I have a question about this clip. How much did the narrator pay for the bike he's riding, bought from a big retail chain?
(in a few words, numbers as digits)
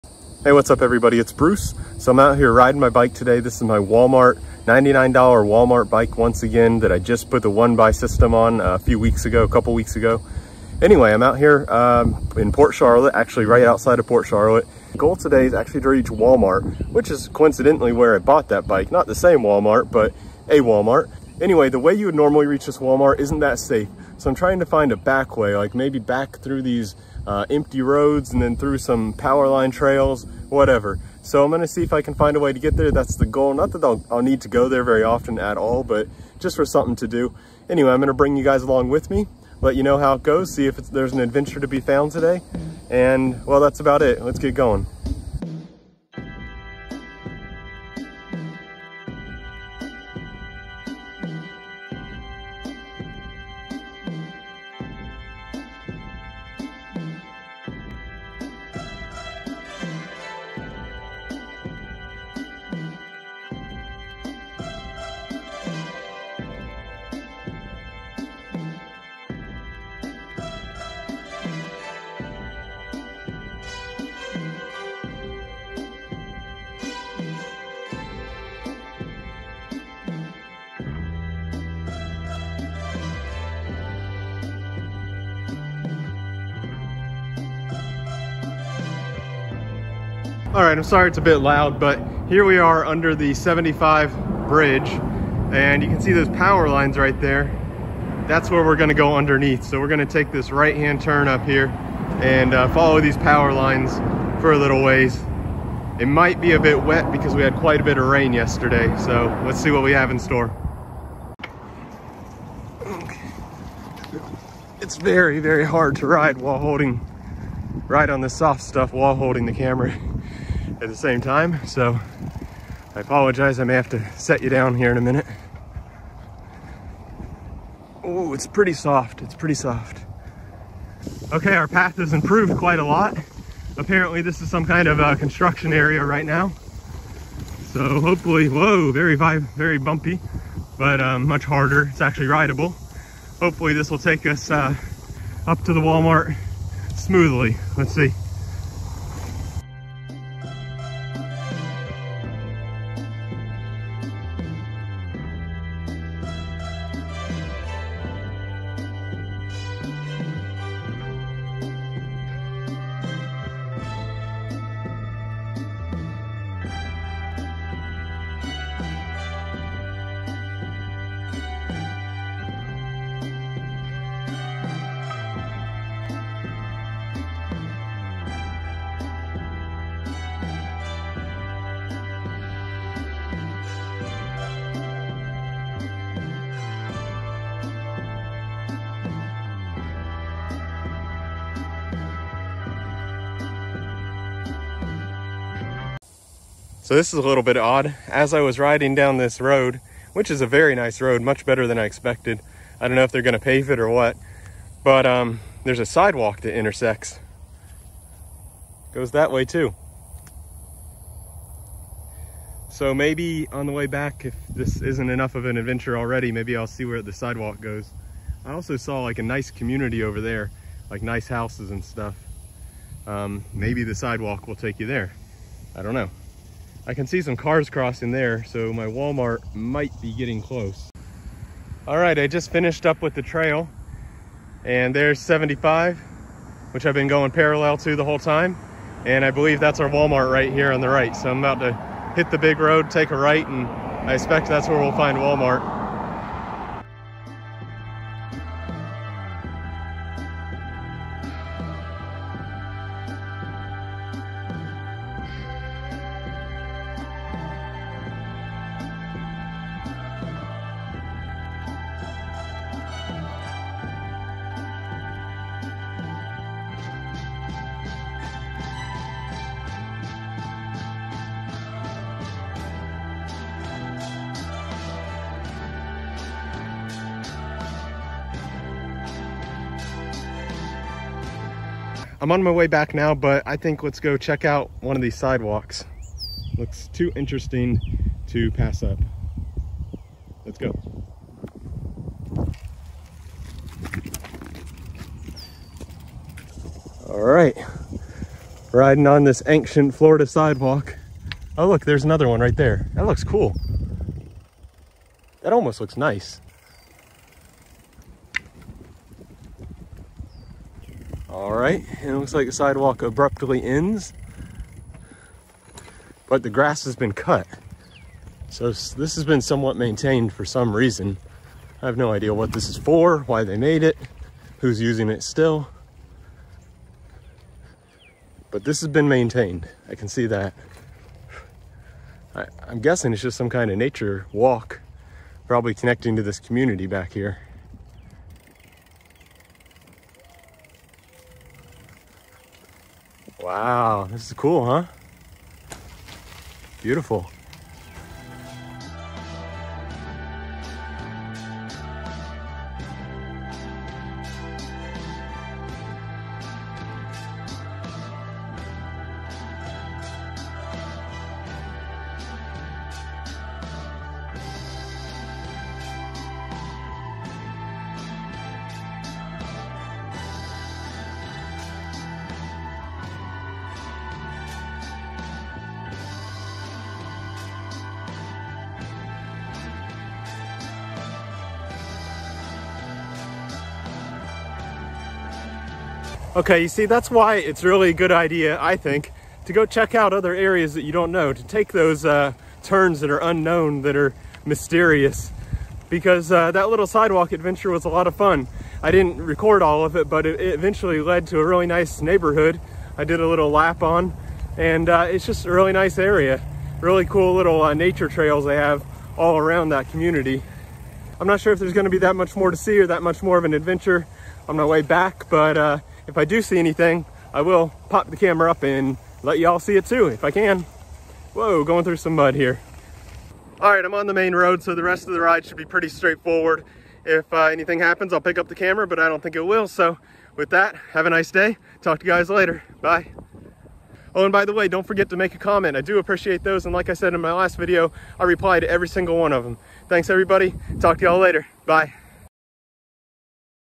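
$99.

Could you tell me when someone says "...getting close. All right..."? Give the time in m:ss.
3:50.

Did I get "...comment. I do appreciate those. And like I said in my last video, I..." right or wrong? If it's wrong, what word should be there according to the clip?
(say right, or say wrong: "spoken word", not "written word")
right.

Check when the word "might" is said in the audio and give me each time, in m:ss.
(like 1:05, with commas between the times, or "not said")
1:46, 3:49.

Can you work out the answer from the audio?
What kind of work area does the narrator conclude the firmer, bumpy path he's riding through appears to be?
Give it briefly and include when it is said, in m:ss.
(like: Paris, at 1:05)
Construction area, at 2:15.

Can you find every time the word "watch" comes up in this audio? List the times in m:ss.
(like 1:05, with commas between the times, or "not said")
not said.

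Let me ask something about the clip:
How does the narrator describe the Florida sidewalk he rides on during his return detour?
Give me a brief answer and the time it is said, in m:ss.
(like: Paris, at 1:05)
Ancient, at 4:59.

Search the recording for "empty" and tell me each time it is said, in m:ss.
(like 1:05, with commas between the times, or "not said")
0:27.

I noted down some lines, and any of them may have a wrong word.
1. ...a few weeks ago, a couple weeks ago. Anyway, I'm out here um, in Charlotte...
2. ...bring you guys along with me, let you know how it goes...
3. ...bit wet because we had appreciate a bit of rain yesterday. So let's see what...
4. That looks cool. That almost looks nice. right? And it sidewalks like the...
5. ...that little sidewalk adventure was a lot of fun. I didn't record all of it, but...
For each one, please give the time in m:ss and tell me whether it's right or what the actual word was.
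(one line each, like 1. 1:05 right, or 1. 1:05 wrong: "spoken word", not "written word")
1. 0:08 wrong: "Port", not "Charlotte"
2. 0:38 right
3. 1:46 wrong: "quite", not "appreciate"
4. 5:02 wrong: "looks", not "sidewalks"
5. 6:36 right.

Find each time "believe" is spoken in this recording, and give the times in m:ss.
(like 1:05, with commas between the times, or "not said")
3:59.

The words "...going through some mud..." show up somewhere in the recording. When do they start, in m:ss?
7:01.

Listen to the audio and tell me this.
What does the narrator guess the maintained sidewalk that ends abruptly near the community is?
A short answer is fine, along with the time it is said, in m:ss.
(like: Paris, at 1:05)
Nature walk, at 5:33.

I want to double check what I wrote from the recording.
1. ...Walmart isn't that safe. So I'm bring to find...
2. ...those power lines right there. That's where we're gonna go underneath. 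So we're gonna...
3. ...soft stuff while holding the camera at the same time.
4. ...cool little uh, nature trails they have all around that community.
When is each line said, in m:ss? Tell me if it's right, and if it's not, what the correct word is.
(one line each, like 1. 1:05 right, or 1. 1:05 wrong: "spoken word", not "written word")
1. 0:22 wrong: "trying", not "bring"
2. 1:36 right
3. 1:58 right
4. 6:47 right.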